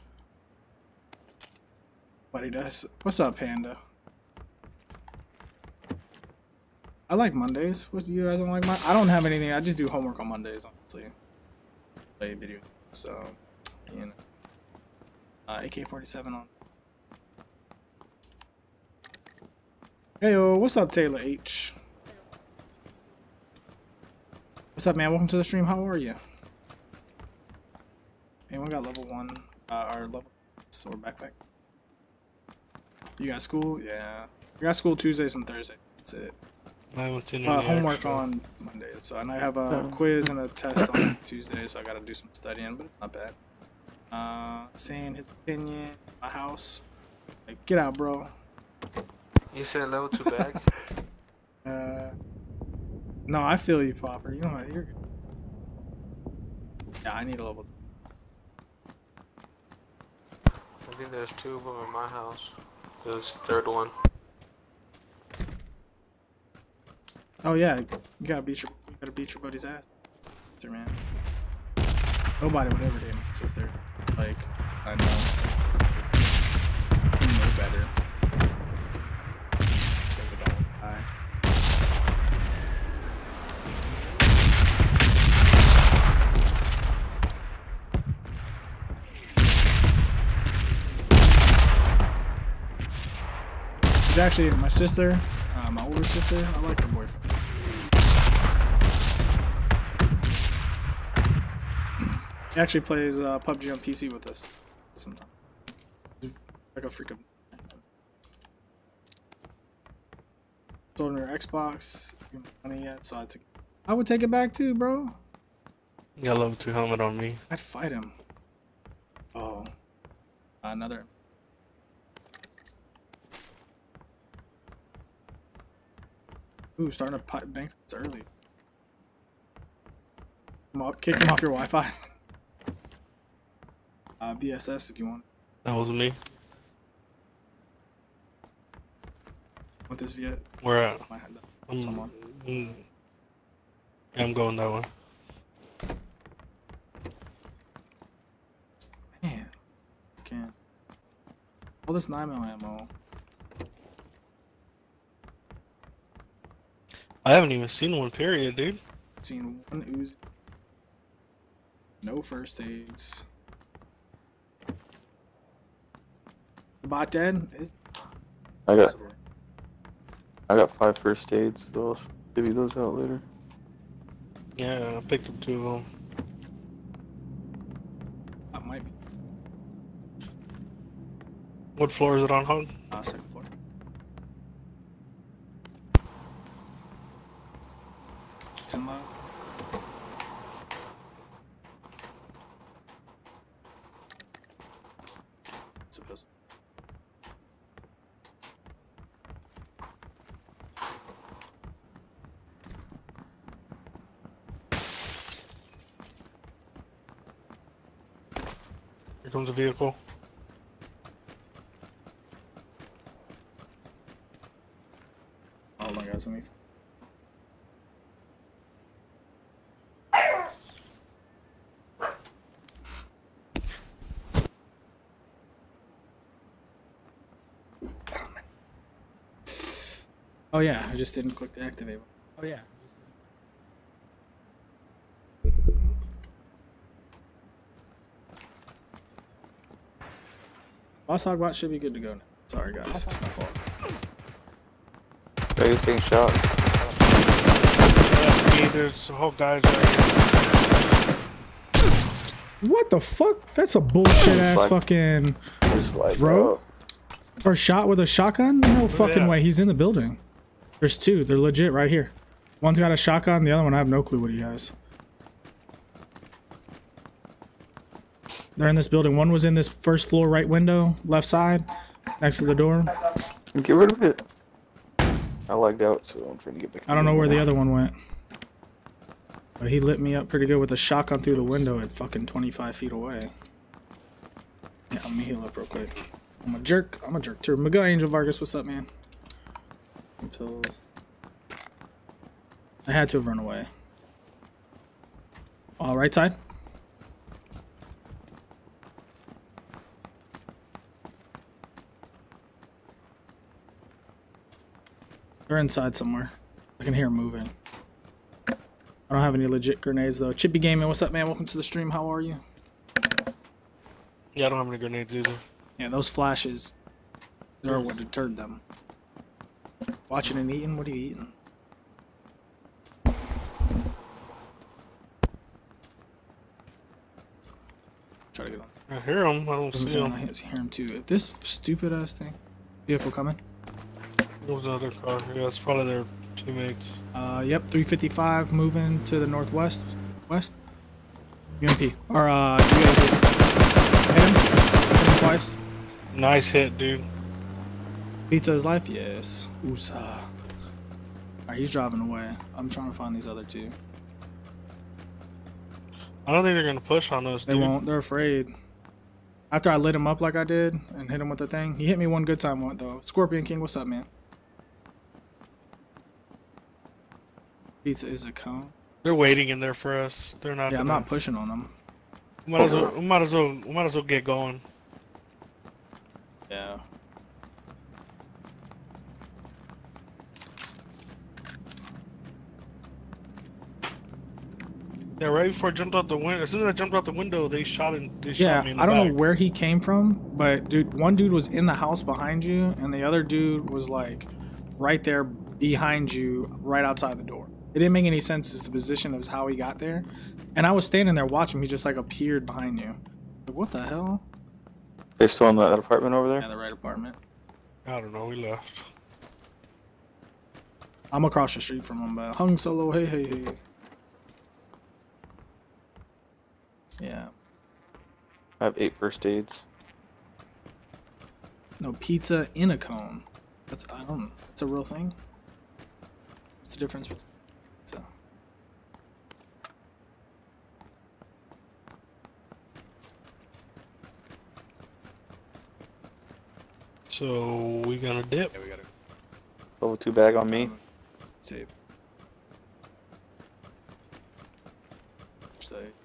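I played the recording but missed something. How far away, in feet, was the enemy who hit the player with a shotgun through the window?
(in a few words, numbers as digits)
25 feet.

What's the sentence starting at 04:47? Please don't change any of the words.
My guy Angel Vargas, what's up, man?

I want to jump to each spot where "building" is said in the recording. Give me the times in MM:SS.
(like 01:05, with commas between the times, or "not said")
04:19, 04:28.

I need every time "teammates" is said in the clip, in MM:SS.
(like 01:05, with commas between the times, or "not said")
05:36.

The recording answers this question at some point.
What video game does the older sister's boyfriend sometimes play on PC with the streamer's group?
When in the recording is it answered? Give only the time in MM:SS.
01:43.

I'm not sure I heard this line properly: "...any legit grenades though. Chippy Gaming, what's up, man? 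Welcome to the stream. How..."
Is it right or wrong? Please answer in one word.
right.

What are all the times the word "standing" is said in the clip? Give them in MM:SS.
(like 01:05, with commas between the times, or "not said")
06:40.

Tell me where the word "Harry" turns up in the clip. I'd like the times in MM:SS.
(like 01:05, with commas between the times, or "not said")
not said.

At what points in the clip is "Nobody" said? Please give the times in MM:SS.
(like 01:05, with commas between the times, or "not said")
01:12.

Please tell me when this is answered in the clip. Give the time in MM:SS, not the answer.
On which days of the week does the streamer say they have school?
00:34.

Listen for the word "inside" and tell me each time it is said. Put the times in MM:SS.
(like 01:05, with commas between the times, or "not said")
05:05.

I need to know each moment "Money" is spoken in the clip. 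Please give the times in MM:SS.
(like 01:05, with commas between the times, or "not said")
01:52.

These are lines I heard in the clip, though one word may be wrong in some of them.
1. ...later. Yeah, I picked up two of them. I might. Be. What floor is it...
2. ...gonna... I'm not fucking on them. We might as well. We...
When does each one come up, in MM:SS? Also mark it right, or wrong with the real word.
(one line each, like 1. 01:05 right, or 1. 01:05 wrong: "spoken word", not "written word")
1. 02:52 right
2. 06:10 wrong: "pushing", not "fucking".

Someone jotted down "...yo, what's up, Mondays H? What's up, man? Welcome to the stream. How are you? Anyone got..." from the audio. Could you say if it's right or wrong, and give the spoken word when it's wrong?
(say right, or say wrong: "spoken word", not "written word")
wrong: "Taylor", not "Mondays".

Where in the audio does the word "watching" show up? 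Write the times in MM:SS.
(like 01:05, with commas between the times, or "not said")
05:20, 06:41.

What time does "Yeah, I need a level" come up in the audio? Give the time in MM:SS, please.
00:57.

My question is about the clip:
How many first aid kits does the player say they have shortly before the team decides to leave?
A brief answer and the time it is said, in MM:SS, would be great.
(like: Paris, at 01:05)
8, at 06:58.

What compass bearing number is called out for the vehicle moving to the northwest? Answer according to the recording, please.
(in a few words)
355.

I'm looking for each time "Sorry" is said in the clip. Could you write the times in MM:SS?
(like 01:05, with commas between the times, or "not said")
04:02.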